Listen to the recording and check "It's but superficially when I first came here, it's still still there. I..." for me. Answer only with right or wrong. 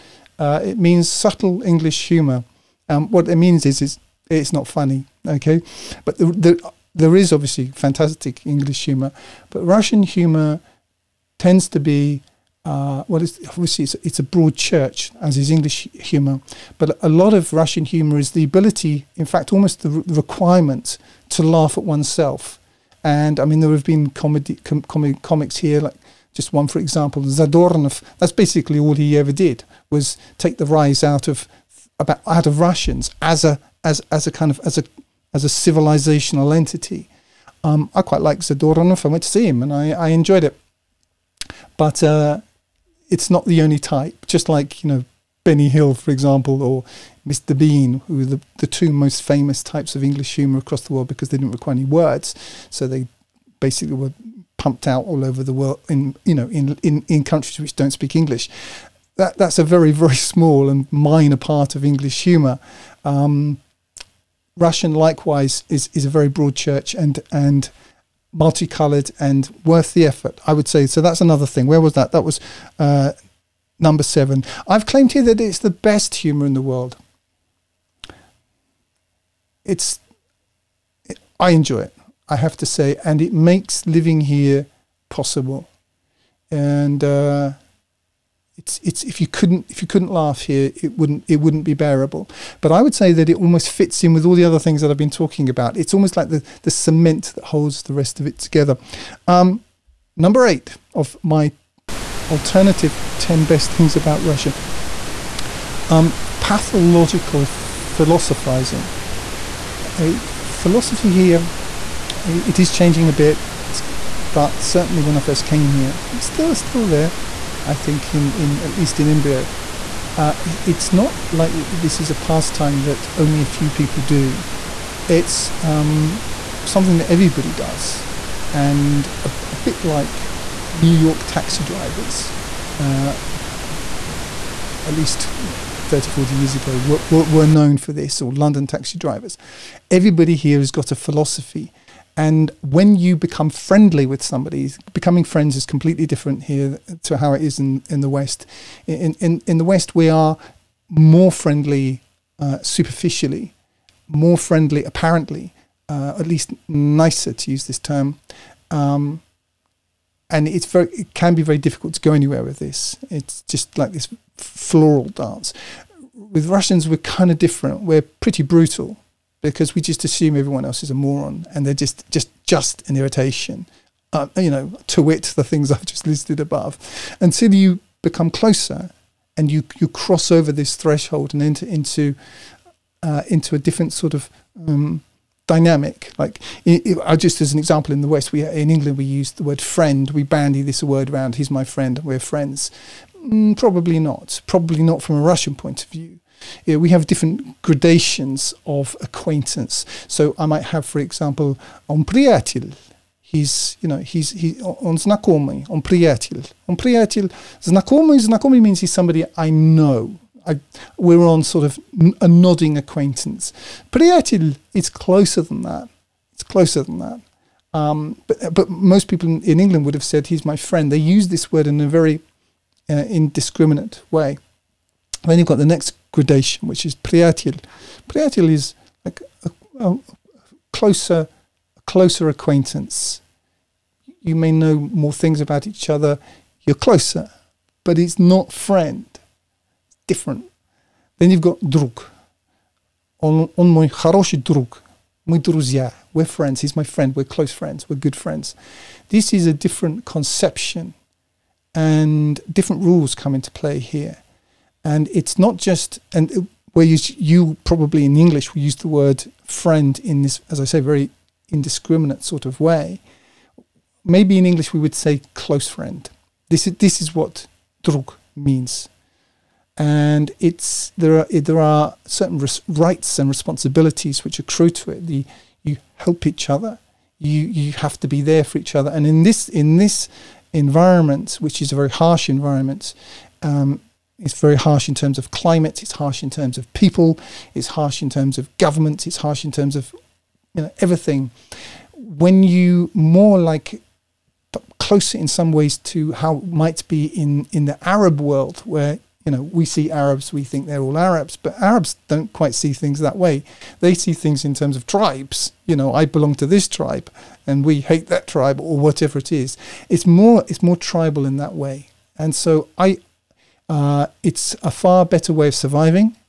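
wrong.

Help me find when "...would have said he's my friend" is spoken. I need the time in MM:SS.
03:39.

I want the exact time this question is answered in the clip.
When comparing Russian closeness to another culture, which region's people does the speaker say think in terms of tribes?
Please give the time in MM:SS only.
04:57.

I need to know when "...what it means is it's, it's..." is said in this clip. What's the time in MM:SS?
00:03.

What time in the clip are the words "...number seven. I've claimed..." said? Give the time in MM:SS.
01:13.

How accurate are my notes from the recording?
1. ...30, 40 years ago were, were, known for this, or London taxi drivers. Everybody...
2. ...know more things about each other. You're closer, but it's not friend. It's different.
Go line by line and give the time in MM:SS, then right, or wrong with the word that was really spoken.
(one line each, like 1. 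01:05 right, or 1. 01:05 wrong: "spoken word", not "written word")
1. 02:15 right
2. 03:54 right.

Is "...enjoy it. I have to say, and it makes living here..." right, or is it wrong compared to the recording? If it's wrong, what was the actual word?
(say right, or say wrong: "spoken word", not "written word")
right.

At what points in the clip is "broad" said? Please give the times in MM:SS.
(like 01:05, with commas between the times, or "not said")
00:14, 01:06.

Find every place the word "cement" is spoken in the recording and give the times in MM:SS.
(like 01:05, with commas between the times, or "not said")
01:36.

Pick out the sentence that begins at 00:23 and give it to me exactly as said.
And I mean, there have been comedy com- com- comics here like just one, for example, Zadornov.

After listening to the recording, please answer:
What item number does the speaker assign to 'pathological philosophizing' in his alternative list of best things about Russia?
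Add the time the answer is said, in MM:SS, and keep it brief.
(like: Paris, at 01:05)
8, at 01:40.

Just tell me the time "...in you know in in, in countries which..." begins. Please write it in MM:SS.
00:55.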